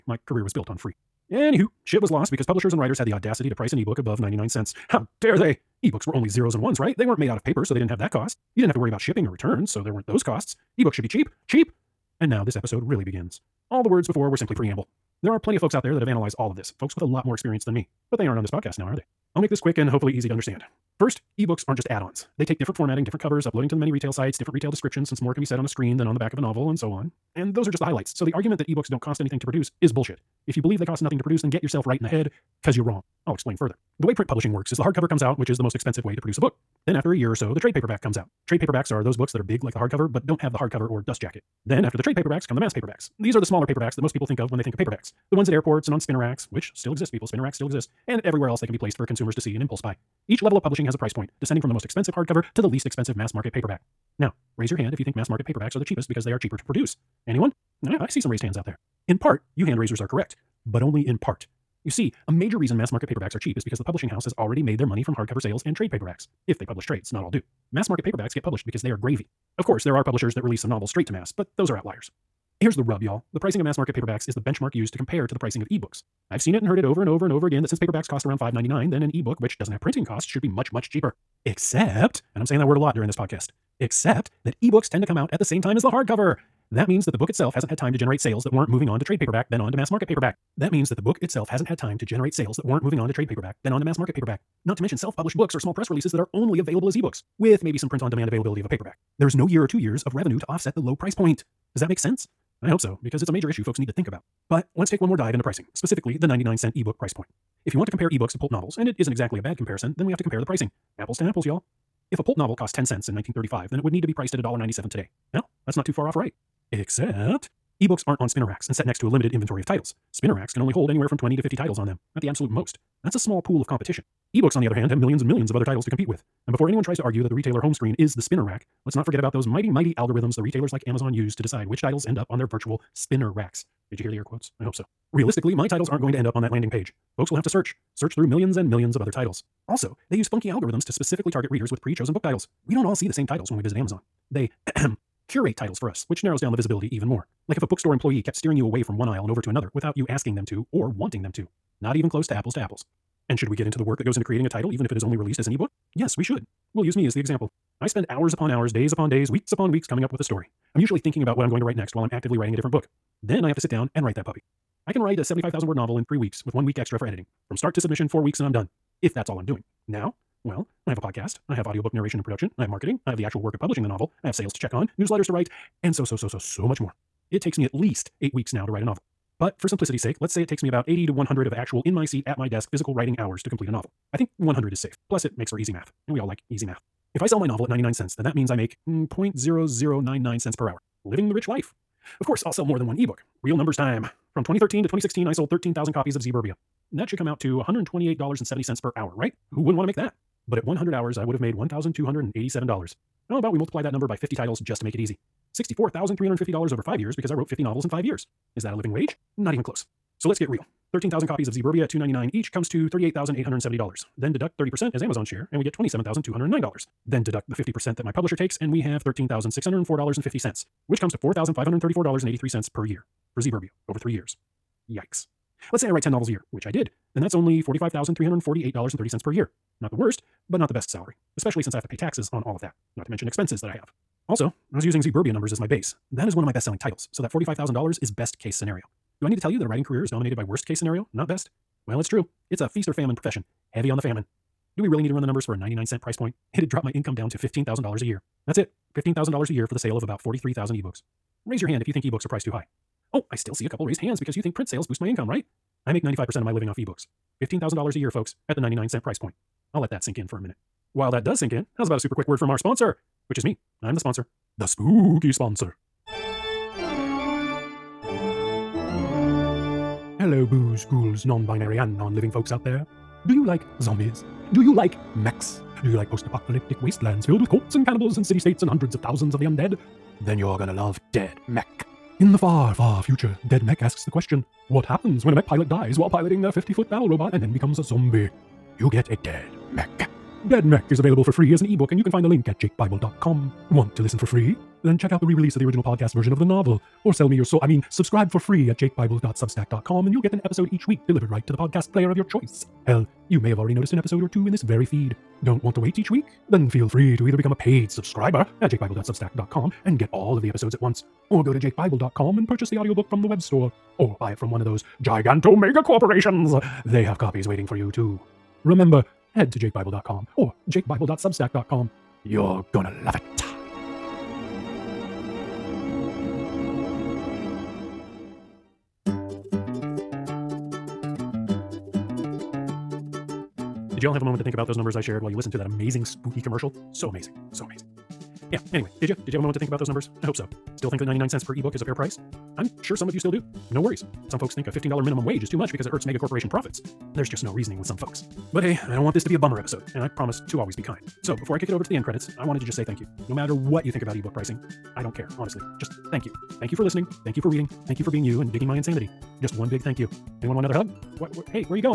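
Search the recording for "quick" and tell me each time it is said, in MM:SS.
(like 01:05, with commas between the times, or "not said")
00:19, 04:22.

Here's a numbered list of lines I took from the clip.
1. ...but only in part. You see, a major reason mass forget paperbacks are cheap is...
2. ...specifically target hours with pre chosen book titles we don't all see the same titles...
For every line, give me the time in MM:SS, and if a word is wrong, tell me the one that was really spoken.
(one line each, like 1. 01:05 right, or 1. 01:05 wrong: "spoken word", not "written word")
1. 01:00 wrong: "market", not "forget"
2. 02:20 wrong: "readers", not "hours".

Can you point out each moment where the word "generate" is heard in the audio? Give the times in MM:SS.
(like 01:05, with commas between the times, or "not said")
01:27, 01:32.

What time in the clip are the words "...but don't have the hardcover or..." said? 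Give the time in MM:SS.
00:40.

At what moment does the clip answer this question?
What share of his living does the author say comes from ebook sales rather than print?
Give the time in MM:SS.
04:16.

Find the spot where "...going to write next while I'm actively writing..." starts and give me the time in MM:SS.
02:41.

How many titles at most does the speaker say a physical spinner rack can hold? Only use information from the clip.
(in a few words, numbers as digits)
50.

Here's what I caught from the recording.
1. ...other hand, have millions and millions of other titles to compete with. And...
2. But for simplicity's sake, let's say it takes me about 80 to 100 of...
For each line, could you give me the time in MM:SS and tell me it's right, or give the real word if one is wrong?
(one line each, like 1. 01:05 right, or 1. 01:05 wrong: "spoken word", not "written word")
1. 02:04 right
2. 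02:59 right.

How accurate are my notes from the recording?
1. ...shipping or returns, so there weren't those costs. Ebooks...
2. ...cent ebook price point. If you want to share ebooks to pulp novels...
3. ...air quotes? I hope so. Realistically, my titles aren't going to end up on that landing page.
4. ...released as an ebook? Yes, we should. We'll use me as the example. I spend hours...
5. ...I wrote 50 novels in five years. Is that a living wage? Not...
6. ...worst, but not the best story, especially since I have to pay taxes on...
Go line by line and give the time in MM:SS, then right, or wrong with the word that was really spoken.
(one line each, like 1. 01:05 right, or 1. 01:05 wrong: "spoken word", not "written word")
1. 00:09 right
2. 01:46 wrong: "compare", not "share"
3. 02:14 right
4. 02:35 right
5. 03:27 right
6. 03:49 wrong: "salary", not "story".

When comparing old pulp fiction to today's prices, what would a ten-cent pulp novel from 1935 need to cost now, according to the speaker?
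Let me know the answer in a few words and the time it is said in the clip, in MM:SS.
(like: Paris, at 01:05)
$1.97, at 01:54.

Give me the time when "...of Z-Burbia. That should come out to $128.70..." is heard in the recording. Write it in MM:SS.
03:16.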